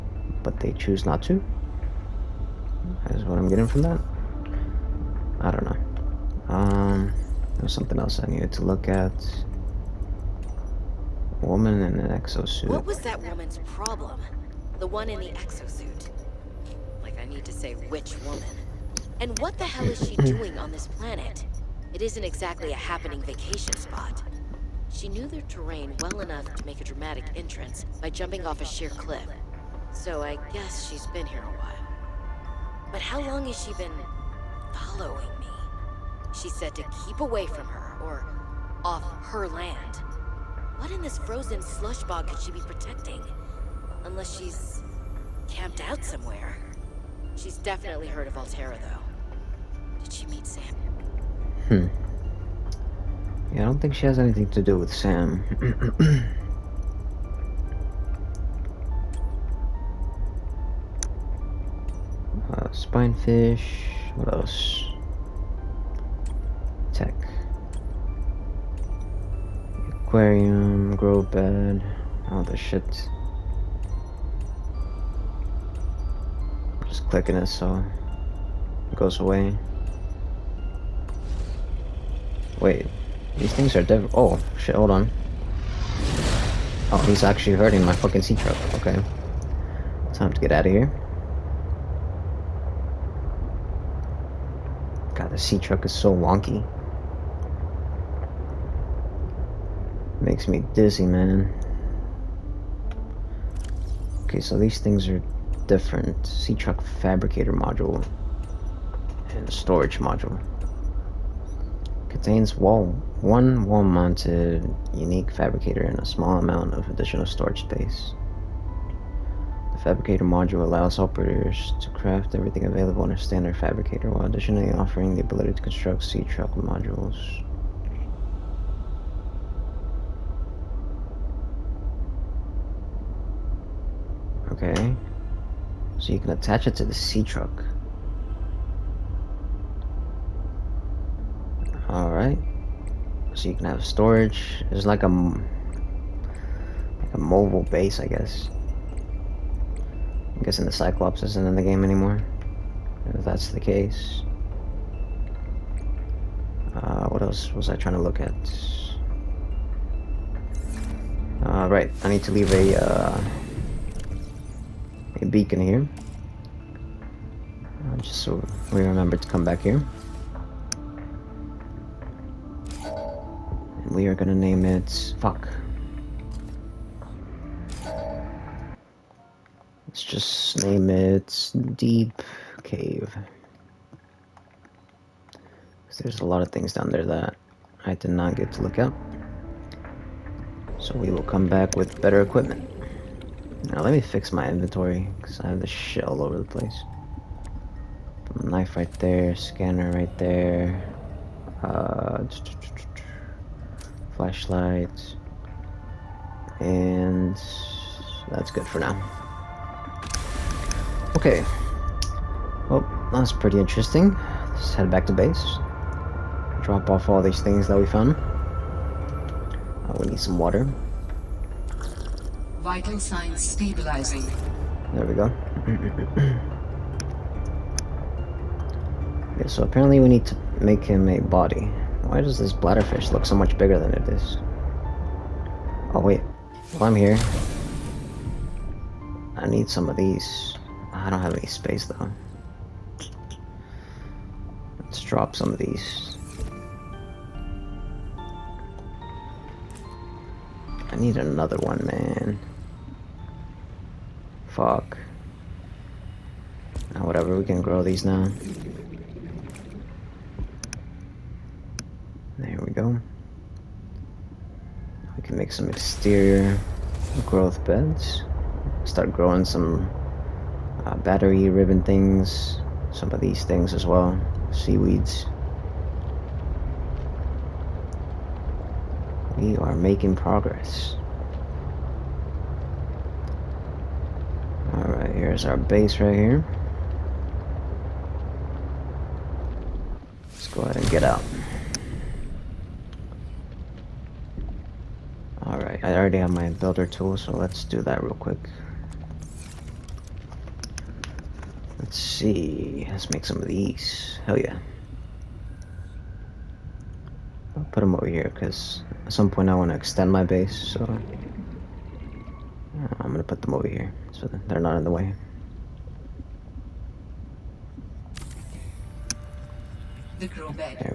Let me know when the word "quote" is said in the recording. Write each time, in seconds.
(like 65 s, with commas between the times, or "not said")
not said.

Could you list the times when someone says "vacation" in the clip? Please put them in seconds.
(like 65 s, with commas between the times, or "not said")
23 s.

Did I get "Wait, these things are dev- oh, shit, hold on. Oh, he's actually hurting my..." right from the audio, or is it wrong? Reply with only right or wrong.
right.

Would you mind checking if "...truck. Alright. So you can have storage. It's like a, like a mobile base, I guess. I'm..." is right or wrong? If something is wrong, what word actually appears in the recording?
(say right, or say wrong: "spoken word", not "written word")
right.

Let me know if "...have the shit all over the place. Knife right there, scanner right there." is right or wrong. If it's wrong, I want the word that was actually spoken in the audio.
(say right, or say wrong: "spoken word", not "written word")
right.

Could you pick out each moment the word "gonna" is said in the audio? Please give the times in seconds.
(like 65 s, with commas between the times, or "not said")
174 s, 313 s.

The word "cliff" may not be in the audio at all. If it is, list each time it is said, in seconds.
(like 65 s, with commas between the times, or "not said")
28 s.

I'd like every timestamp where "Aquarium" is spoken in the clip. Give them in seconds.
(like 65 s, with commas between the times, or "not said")
70 s.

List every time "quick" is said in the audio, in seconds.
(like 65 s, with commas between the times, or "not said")
298 s.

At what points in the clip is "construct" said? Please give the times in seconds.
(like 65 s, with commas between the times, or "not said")
125 s.